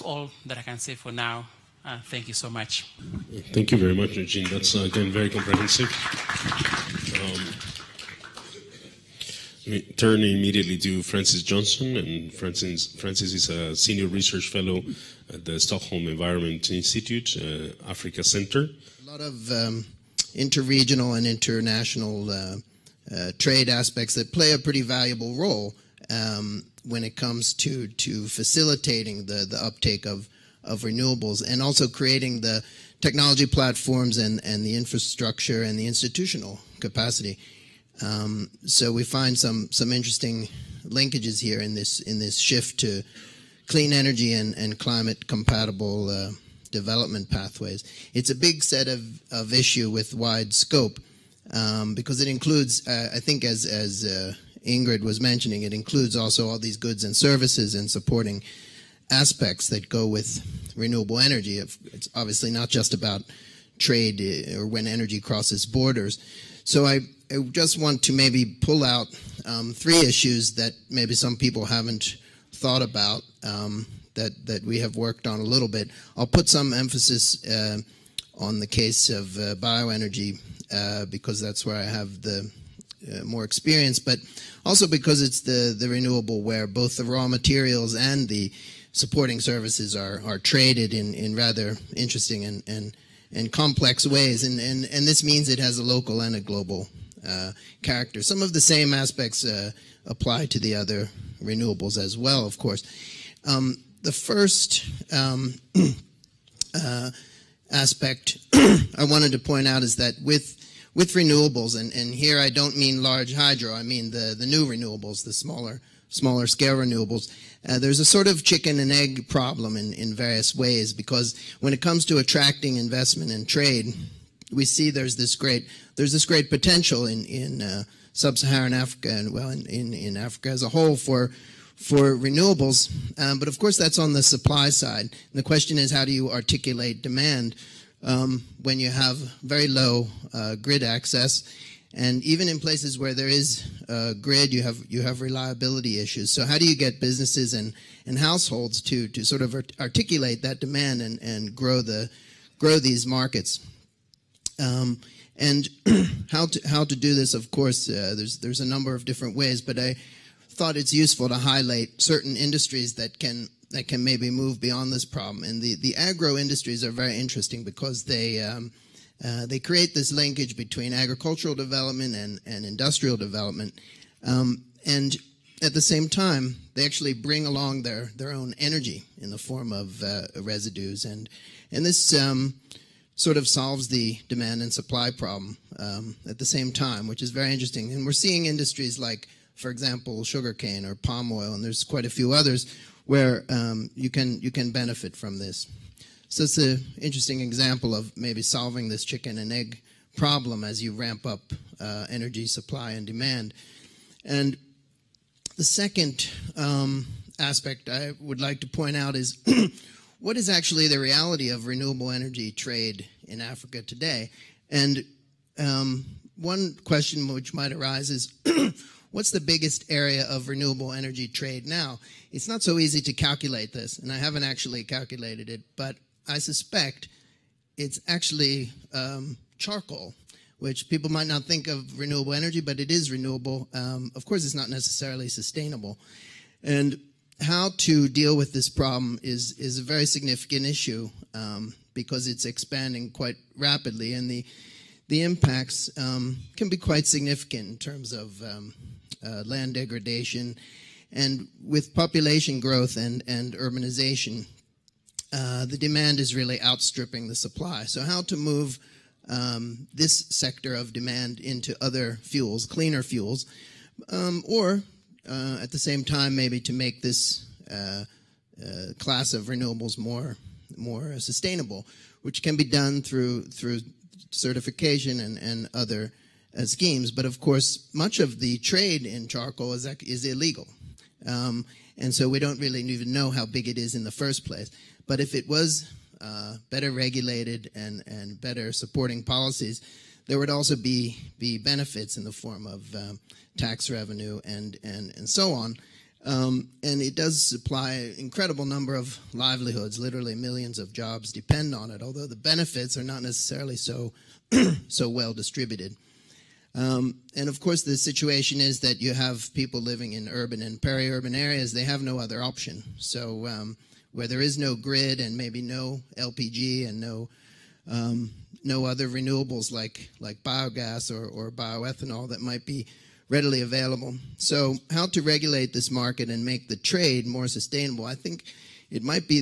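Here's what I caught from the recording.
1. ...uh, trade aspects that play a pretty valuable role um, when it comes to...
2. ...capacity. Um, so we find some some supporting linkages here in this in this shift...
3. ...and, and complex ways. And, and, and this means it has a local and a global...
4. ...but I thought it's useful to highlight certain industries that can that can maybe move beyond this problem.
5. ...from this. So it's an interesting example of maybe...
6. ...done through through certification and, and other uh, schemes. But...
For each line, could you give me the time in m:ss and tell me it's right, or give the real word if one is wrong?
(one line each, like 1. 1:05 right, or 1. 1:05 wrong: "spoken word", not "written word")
1. 0:23 right
2. 0:36 wrong: "interesting", not "supporting"
3. 1:32 right
4. 2:39 right
5. 3:15 right
6. 4:32 right.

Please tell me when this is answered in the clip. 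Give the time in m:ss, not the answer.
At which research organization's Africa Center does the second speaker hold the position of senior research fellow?
0:15.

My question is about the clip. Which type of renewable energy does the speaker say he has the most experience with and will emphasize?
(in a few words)
Bioenergy.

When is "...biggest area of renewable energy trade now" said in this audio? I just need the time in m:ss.
3:39.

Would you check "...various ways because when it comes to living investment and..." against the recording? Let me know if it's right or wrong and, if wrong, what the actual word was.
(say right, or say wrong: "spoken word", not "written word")
wrong: "attracting", not "living".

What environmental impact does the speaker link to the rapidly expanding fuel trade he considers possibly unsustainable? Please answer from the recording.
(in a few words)
Land degradation.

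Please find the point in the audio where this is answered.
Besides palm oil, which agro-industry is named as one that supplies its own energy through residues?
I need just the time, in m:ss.
3:10.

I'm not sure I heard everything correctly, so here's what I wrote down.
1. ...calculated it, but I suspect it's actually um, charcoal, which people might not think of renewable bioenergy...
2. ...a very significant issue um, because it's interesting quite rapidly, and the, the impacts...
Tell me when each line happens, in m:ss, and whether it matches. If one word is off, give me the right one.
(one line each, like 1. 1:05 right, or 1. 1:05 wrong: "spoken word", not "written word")
1. 3:44 wrong: "energy", not "bioenergy"
2. 3:59 wrong: "expanding", not "interesting".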